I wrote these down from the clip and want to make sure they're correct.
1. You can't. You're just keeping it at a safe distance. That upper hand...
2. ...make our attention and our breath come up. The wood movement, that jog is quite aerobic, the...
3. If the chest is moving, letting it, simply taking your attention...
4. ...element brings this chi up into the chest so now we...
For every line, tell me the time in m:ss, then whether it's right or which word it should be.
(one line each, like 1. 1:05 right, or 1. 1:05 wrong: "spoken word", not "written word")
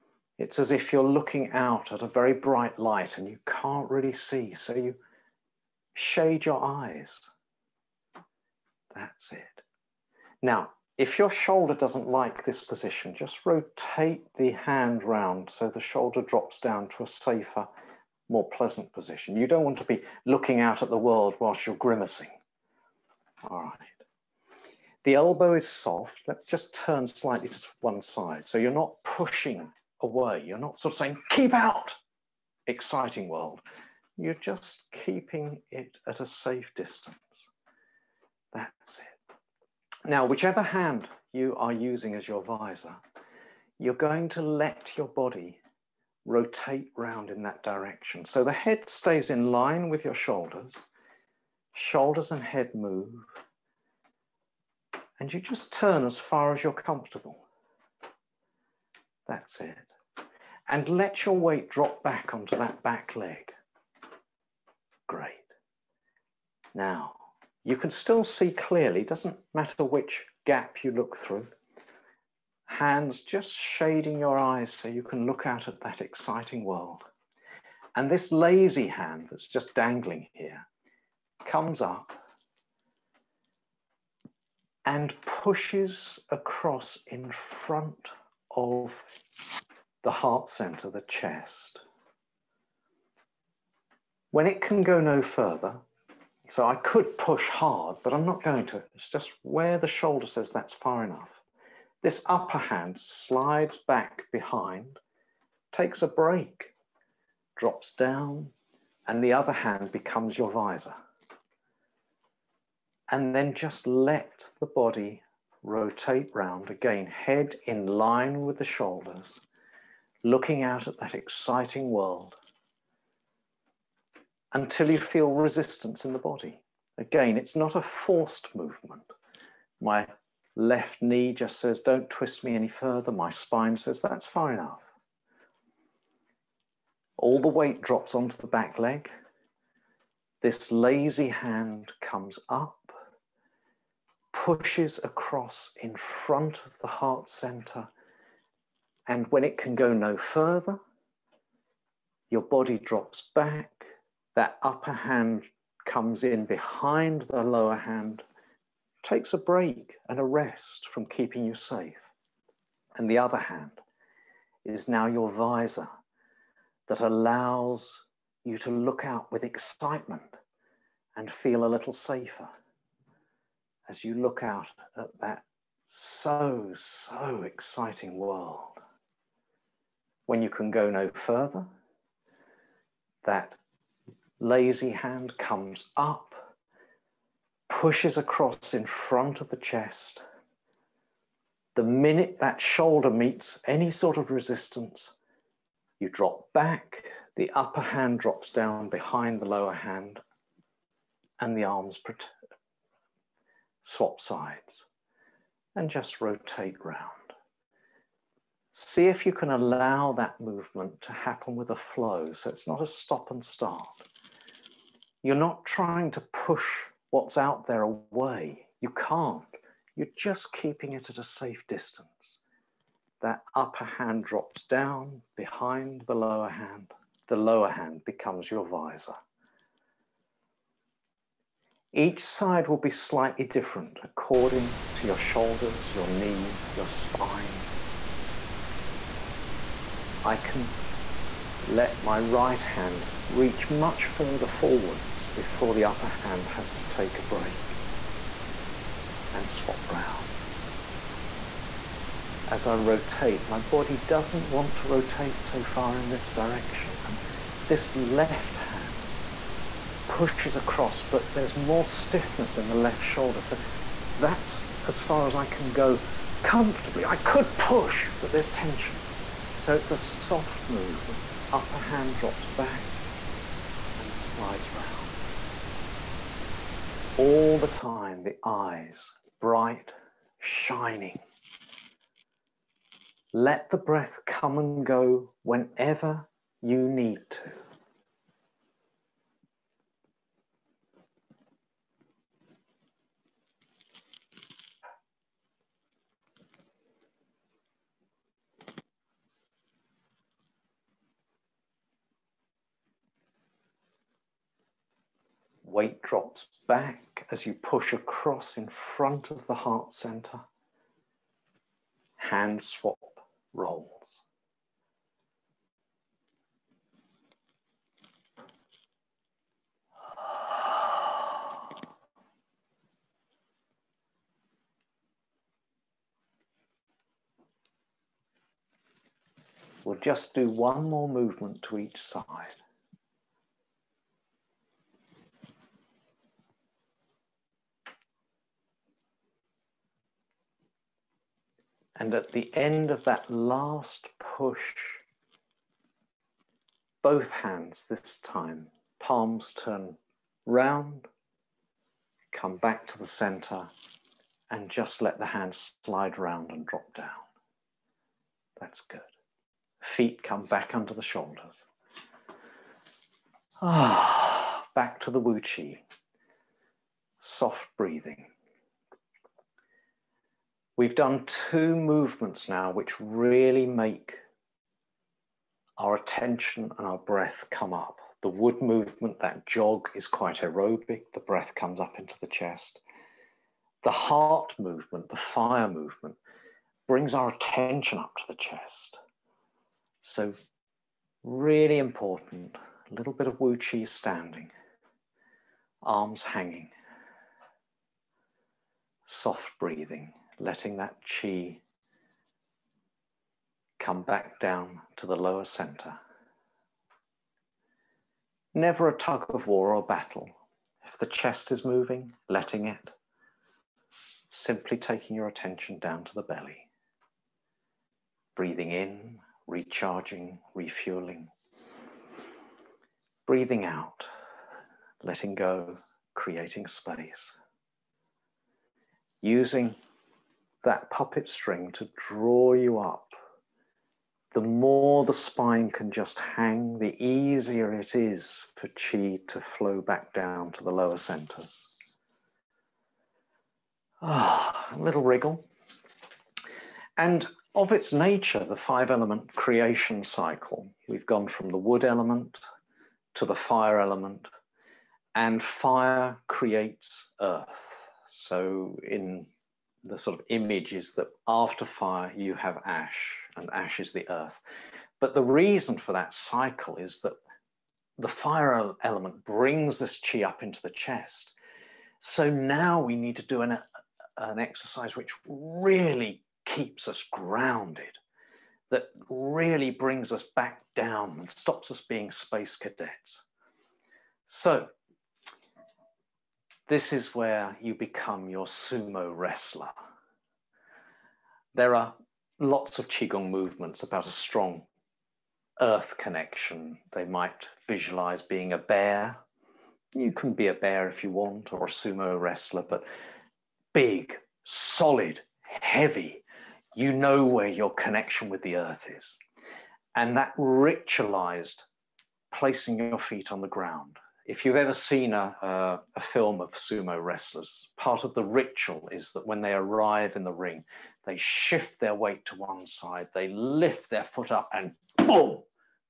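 1. 3:38 right
2. 6:13 right
3. 6:50 right
4. 7:48 right.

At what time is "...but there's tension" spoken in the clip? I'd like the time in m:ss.
4:28.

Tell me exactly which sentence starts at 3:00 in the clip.
When you can go no further, that lazy hand comes up, pushes across in front of the chest.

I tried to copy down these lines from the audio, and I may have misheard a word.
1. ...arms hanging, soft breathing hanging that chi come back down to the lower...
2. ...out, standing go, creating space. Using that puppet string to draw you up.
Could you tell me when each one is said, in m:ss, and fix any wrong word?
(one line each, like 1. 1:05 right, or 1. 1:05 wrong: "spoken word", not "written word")
1. 6:35 wrong: "letting", not "hanging"
2. 7:03 wrong: "letting", not "standing".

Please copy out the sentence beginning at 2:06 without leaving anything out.
Again, it's not a forced movement.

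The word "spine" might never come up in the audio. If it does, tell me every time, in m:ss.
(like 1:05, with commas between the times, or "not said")
2:13, 3:56, 7:15.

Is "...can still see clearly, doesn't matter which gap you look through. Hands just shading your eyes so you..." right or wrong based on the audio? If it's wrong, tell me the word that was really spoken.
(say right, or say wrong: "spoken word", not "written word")
right.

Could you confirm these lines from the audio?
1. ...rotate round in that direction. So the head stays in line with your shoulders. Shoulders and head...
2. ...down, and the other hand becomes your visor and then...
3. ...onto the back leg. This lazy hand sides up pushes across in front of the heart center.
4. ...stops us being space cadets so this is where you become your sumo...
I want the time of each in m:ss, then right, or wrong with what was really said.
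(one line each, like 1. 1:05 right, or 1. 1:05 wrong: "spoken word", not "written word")
1. 0:46 right
2. 1:47 right
3. 2:18 wrong: "comes", not "sides"
4. 8:01 right.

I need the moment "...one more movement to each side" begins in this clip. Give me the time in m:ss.
5:30.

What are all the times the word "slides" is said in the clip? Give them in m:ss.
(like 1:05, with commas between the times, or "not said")
1:42, 4:34, 5:55.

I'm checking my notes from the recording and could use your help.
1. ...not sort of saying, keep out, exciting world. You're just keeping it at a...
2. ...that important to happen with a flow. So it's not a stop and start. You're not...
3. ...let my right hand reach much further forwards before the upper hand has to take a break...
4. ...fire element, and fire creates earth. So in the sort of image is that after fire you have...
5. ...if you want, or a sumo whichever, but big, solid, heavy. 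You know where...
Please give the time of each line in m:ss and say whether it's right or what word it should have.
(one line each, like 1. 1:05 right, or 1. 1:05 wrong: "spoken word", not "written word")
1. 0:30 right
2. 3:30 wrong: "movement", not "important"
3. 4:01 right
4. 7:33 right
5. 8:20 wrong: "wrestler", not "whichever".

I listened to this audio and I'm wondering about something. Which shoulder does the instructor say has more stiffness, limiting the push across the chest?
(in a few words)
left shoulder.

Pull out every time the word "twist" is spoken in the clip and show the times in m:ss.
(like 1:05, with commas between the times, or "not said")
2:12.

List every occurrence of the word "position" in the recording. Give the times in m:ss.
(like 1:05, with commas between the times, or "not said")
0:12, 0:18.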